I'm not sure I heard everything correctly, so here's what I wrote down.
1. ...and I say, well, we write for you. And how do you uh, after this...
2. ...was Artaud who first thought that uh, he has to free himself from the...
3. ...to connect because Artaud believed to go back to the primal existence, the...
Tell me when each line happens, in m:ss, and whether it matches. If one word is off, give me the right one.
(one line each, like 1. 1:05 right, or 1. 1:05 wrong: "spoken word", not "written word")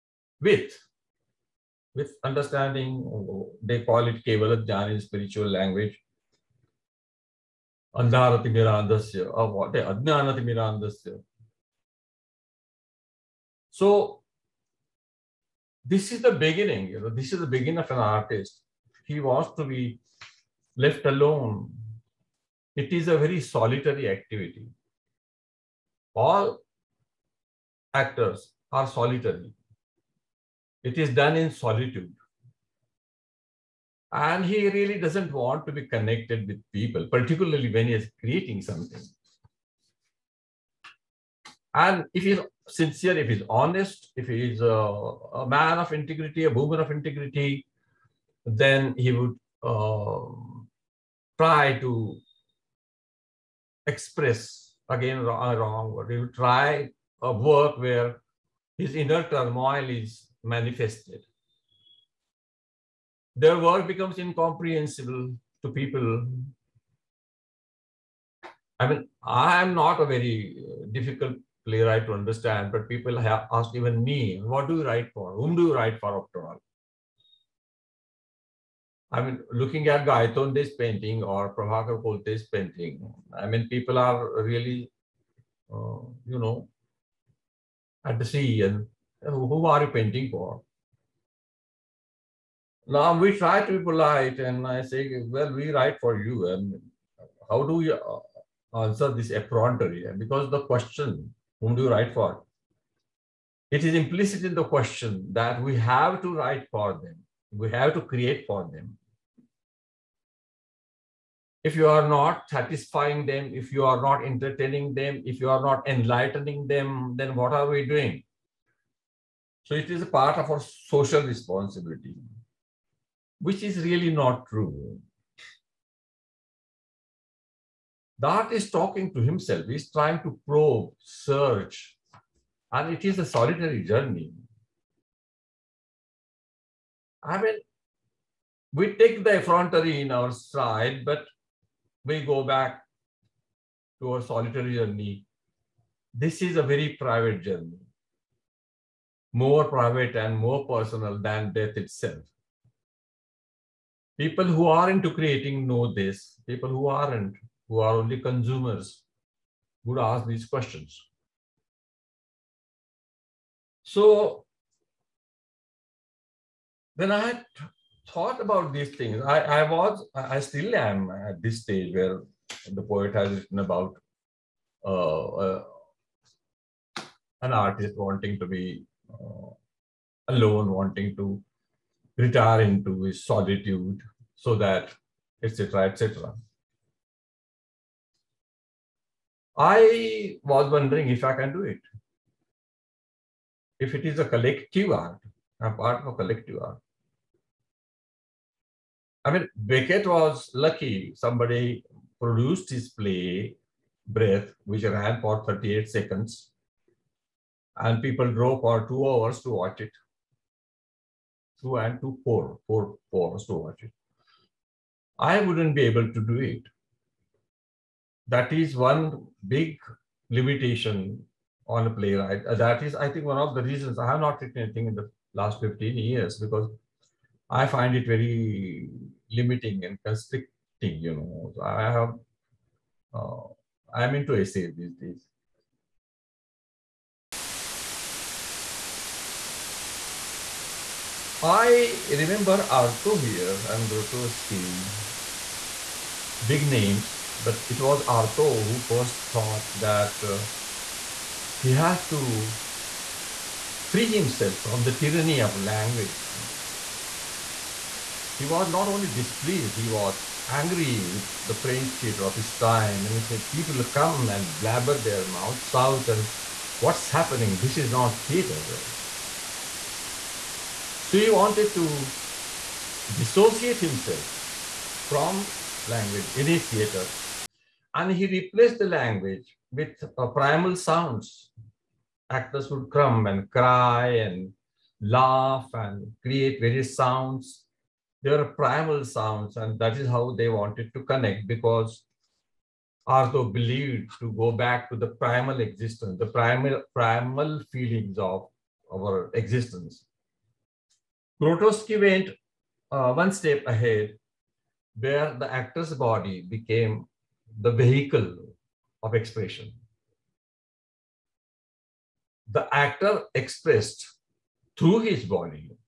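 1. 1:34 wrong: "answer", not "after"
2. 4:07 right
3. 4:50 right.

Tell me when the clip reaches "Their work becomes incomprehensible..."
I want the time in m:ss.
1:03.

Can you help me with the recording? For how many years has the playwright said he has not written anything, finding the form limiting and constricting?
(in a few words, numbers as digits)
15.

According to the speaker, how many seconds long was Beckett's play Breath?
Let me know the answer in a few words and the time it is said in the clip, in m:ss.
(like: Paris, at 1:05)
38, at 3:25.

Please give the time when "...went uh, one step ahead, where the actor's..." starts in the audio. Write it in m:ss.
5:01.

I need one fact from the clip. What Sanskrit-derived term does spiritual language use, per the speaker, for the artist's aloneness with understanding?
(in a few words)
Kevala.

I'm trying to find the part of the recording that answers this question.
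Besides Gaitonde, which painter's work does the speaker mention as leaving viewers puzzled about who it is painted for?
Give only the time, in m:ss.
1:21.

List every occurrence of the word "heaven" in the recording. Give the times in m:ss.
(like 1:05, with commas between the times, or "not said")
not said.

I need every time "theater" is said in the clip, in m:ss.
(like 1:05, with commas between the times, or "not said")
4:21, 4:28, 4:36.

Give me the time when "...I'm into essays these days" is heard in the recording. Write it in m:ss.
3:53.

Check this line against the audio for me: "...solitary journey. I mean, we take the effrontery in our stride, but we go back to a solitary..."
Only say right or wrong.
right.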